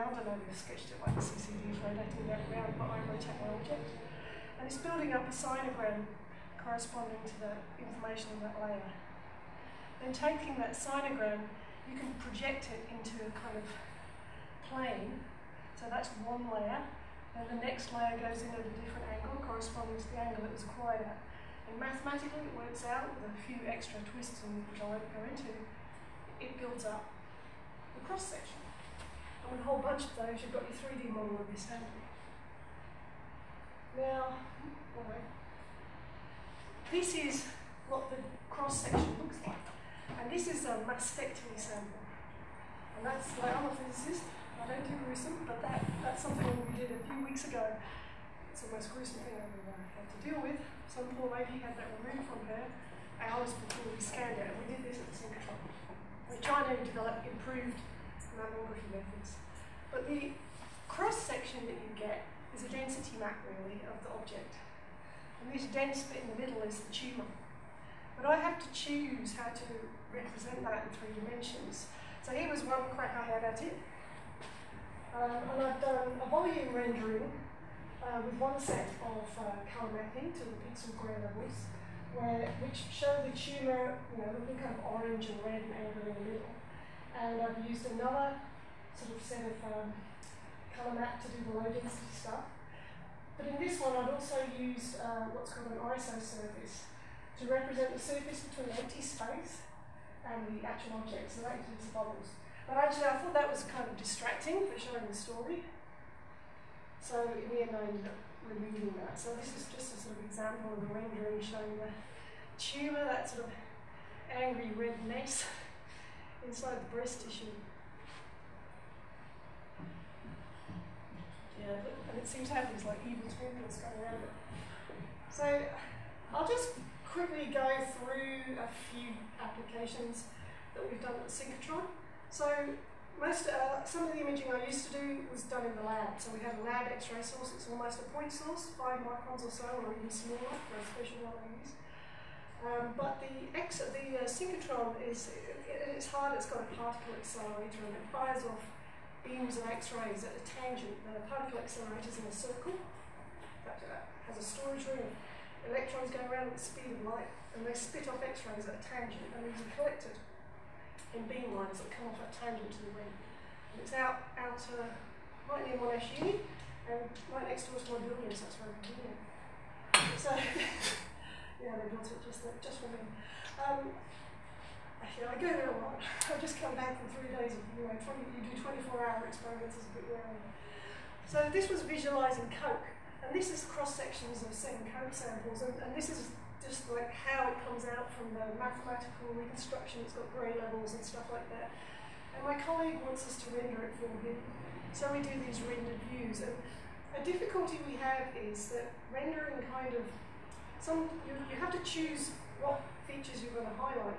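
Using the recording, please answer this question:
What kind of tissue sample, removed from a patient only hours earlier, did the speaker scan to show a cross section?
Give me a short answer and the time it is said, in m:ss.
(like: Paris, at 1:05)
Mastectomy sample, at 0:40.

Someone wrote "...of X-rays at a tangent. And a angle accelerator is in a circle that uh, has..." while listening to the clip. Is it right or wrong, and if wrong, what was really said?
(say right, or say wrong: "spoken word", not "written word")
wrong: "particle", not "angle".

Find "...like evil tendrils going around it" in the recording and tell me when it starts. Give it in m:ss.
2:02.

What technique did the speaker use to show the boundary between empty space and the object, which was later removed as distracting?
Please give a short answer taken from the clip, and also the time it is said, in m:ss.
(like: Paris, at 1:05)
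Iso surface, at 1:35.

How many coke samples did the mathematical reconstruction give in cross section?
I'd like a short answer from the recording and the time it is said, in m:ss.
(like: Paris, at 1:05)
7, at 3:04.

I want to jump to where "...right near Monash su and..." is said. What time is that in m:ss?
2:45.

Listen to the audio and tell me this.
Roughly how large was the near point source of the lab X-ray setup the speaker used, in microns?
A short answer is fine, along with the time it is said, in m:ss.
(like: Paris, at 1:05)
5 microns, at 2:18.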